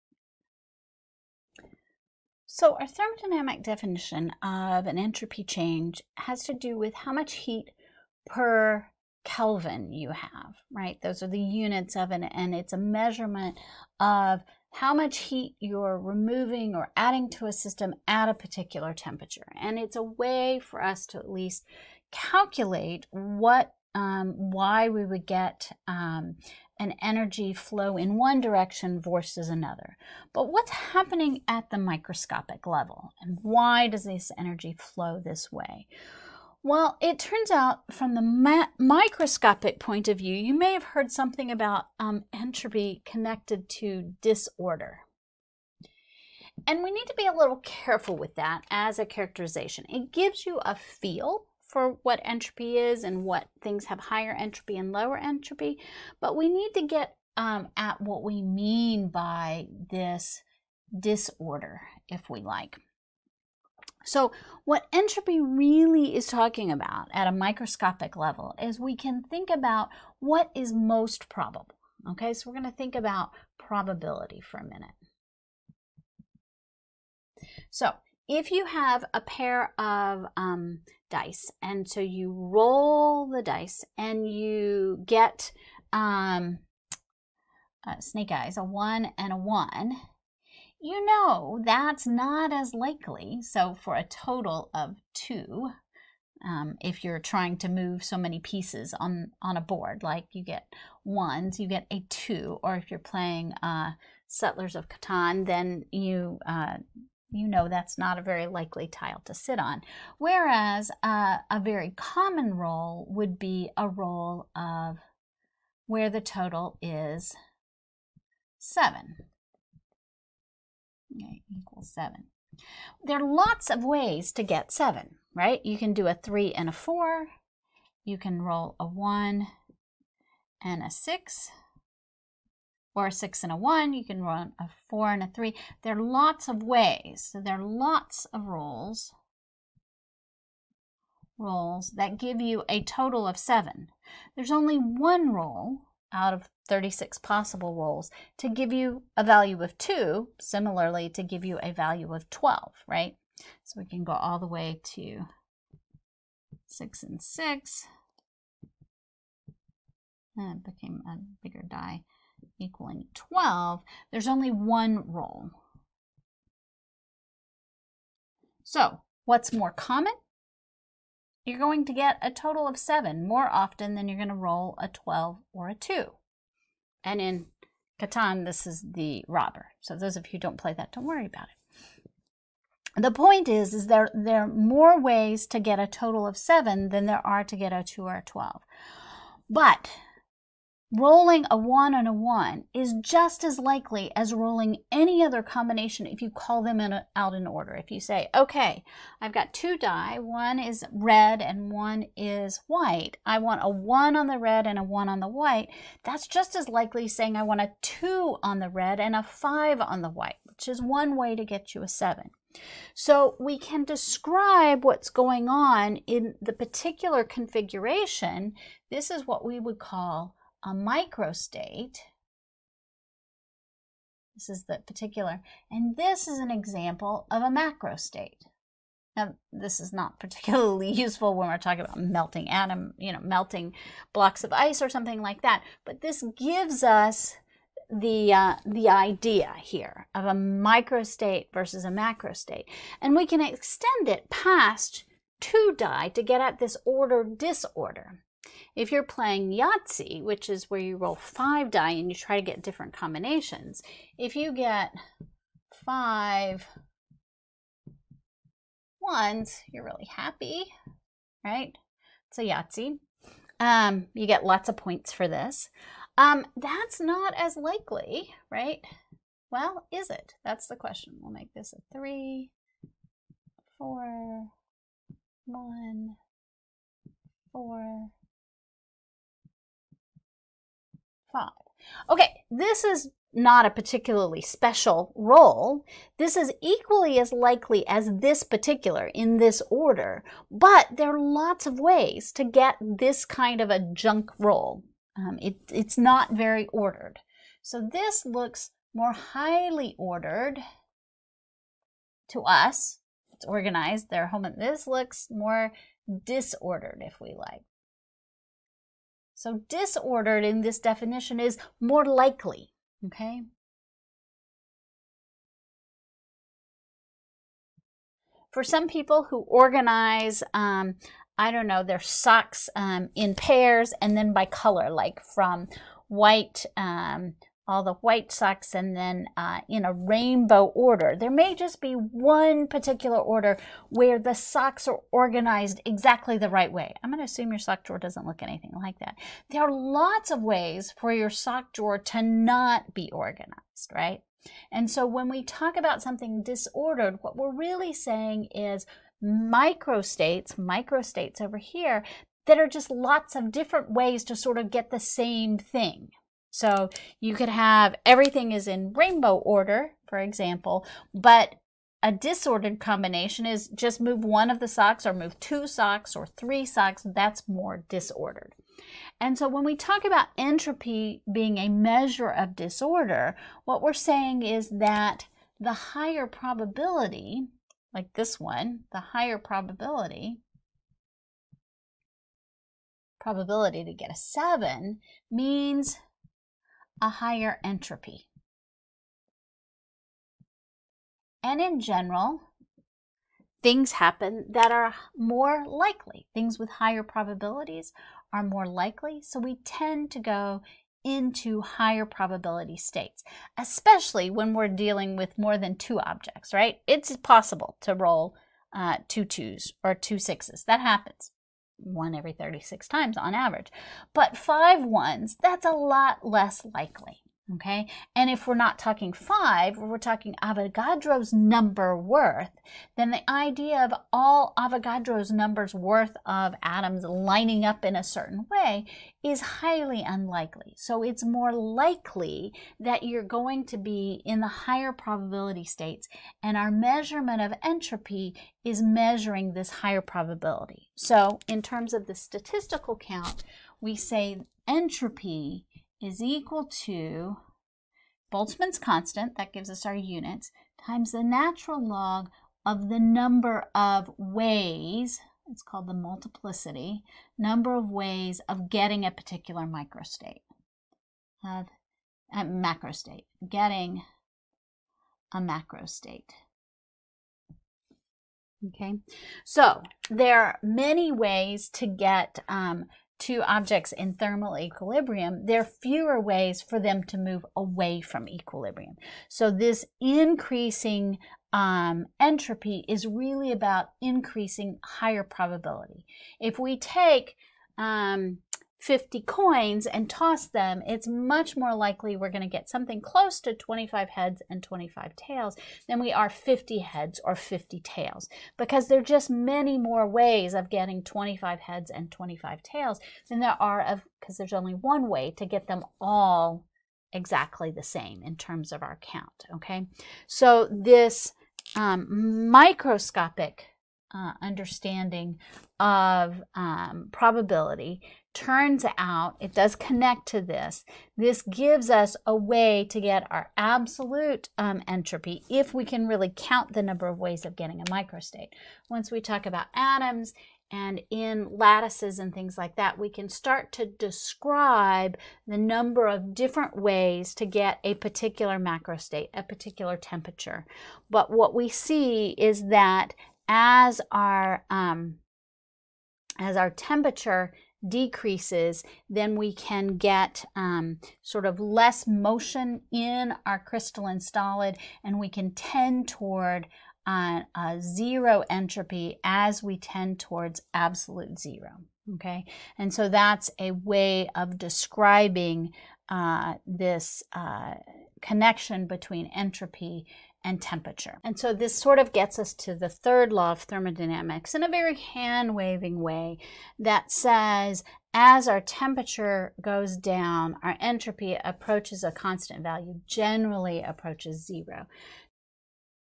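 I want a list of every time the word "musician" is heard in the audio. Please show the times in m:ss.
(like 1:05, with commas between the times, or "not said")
not said.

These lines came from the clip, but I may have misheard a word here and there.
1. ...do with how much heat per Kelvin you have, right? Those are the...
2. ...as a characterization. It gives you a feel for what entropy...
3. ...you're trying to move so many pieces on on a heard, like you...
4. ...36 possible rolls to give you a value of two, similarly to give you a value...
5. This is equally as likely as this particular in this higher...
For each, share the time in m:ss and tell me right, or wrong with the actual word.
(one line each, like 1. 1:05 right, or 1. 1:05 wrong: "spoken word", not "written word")
1. 0:06 right
2. 0:48 right
3. 1:37 wrong: "board", not "heard"
4. 2:26 right
5. 4:46 wrong: "order", not "higher".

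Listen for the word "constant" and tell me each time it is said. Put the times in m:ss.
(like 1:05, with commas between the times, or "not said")
7:28, 9:42.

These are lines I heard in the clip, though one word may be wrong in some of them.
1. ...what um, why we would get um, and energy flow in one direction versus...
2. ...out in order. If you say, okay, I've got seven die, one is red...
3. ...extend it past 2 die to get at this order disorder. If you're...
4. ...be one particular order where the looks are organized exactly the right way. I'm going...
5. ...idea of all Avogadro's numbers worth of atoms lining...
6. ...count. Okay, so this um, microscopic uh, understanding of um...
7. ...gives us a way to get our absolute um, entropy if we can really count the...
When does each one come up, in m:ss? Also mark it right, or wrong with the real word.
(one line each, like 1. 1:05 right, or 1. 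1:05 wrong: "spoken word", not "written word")
1. 0:23 right
2. 3:17 wrong: "two", not "seven"
3. 4:03 right
4. 5:31 wrong: "socks", not "looks"
5. 7:03 right
6. 8:28 right
7. 8:41 right.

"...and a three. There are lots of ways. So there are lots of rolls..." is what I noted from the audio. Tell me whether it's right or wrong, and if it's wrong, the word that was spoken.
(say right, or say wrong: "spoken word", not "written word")
right.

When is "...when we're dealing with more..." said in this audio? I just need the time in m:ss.
6:44.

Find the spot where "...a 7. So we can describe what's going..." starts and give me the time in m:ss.
3:31.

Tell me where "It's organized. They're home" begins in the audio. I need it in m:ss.
5:03.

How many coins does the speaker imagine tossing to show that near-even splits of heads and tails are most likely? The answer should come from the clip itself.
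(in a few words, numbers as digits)
50.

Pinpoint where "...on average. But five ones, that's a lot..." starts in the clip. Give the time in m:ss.
6:53.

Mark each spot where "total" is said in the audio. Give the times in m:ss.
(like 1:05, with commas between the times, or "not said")
1:34, 1:56, 2:22, 2:52, 3:05.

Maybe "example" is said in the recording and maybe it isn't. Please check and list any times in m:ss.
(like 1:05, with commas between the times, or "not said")
3:46, 6:00.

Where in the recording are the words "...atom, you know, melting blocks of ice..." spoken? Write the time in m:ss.
3:52.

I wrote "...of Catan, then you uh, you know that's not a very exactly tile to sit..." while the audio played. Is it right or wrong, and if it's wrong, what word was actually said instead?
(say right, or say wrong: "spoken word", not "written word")
wrong: "likely", not "exactly".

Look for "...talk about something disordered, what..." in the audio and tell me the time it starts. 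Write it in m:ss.
5:45.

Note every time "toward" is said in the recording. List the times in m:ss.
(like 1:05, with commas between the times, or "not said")
9:16, 9:20.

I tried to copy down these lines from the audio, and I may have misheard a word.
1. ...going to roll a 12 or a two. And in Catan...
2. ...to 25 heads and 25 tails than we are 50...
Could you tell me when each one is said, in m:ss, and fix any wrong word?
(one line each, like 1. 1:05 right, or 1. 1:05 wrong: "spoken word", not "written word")
1. 2:54 right
2. 8:13 right.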